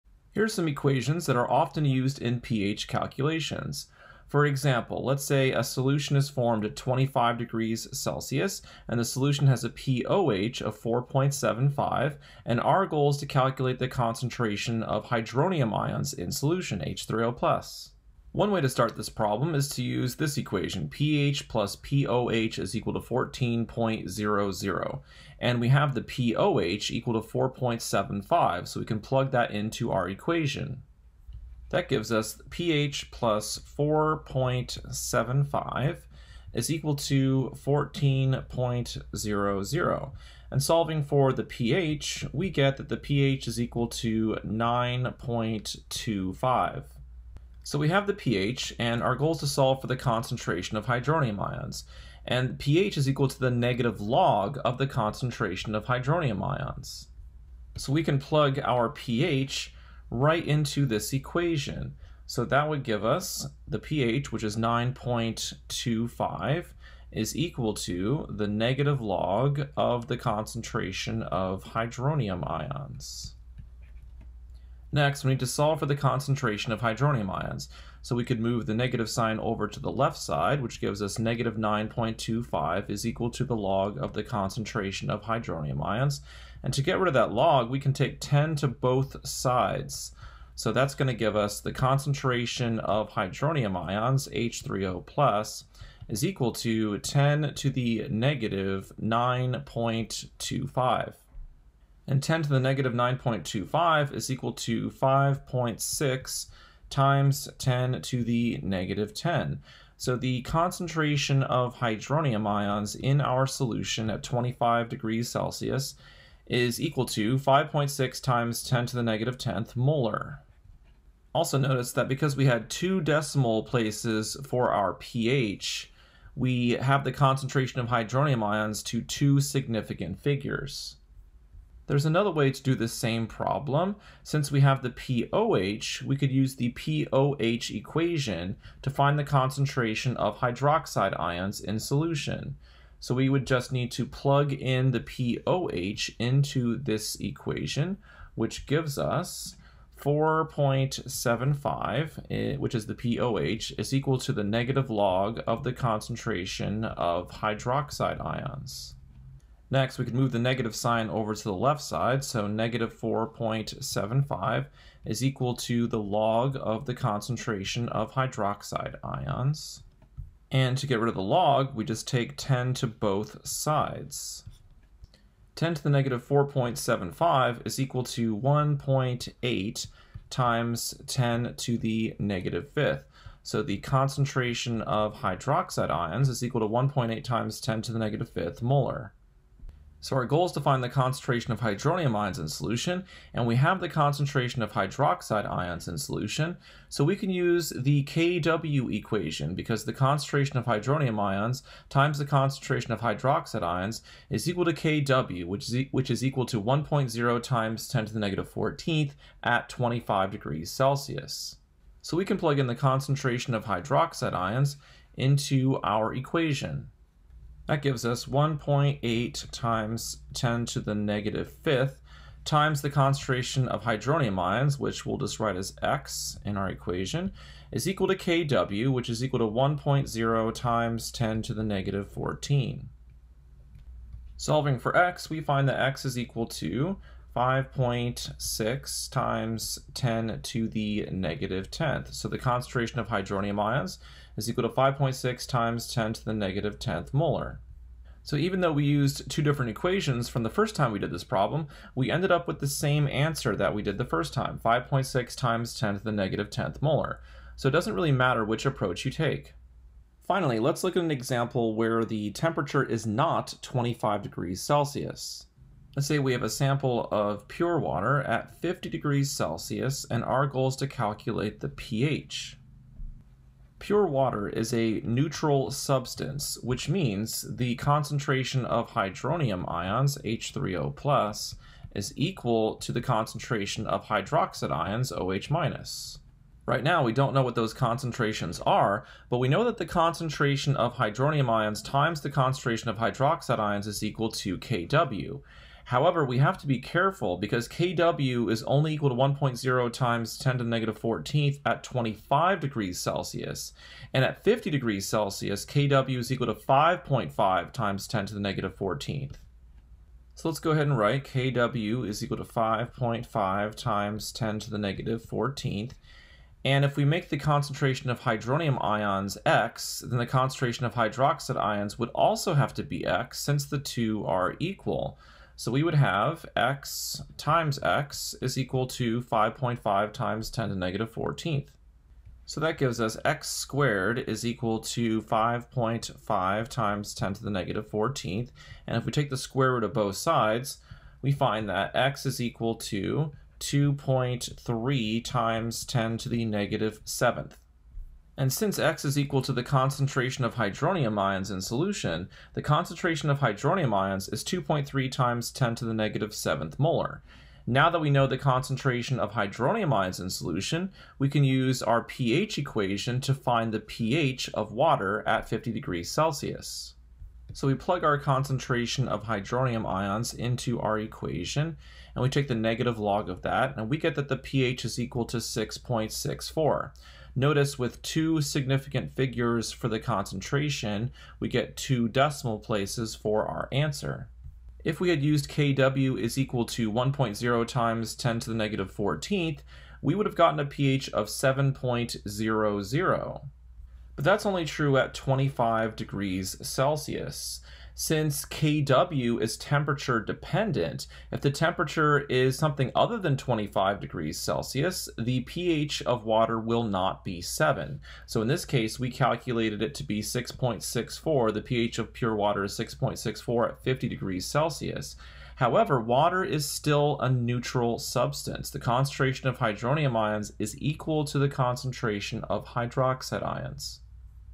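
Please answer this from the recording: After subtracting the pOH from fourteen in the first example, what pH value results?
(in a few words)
9.25.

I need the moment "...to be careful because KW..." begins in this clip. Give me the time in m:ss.
4:56.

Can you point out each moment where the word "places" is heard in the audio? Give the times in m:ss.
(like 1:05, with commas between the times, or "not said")
2:03, 6:22.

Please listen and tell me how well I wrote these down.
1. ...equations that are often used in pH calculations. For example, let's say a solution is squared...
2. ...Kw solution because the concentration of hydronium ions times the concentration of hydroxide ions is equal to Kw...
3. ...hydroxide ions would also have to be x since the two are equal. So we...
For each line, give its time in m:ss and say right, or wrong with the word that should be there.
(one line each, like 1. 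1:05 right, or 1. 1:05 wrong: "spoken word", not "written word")
1. 0:00 wrong: "formed", not "squared"
2. 3:18 wrong: "equation", not "solution"
3. 5:20 right.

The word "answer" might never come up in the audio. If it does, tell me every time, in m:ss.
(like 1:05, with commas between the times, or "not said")
4:13, 6:23.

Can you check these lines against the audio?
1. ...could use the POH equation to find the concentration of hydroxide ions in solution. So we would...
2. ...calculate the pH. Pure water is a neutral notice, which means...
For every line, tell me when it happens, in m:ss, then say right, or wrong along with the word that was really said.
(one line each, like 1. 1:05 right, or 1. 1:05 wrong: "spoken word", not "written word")
1. 2:16 right
2. 4:30 wrong: "substance", not "notice".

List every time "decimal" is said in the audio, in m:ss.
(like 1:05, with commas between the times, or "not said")
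2:02, 6:22.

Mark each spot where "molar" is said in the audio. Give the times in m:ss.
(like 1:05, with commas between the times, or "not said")
1:59, 3:08, 4:07, 4:16, 5:56.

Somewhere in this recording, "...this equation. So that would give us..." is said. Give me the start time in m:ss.
1:00.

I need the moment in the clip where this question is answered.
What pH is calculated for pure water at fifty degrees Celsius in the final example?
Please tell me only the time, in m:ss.
6:14.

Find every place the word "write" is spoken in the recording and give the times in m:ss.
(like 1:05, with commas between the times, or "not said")
3:45, 5:10.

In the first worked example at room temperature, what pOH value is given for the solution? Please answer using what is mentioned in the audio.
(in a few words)
4.75.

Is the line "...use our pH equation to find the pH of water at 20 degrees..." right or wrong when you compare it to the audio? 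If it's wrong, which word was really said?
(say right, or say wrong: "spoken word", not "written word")
wrong: "50", not "20".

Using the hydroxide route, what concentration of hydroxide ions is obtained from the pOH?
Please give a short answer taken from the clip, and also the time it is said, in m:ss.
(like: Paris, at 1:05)
1.8 x 10^-5 M, at 3:06.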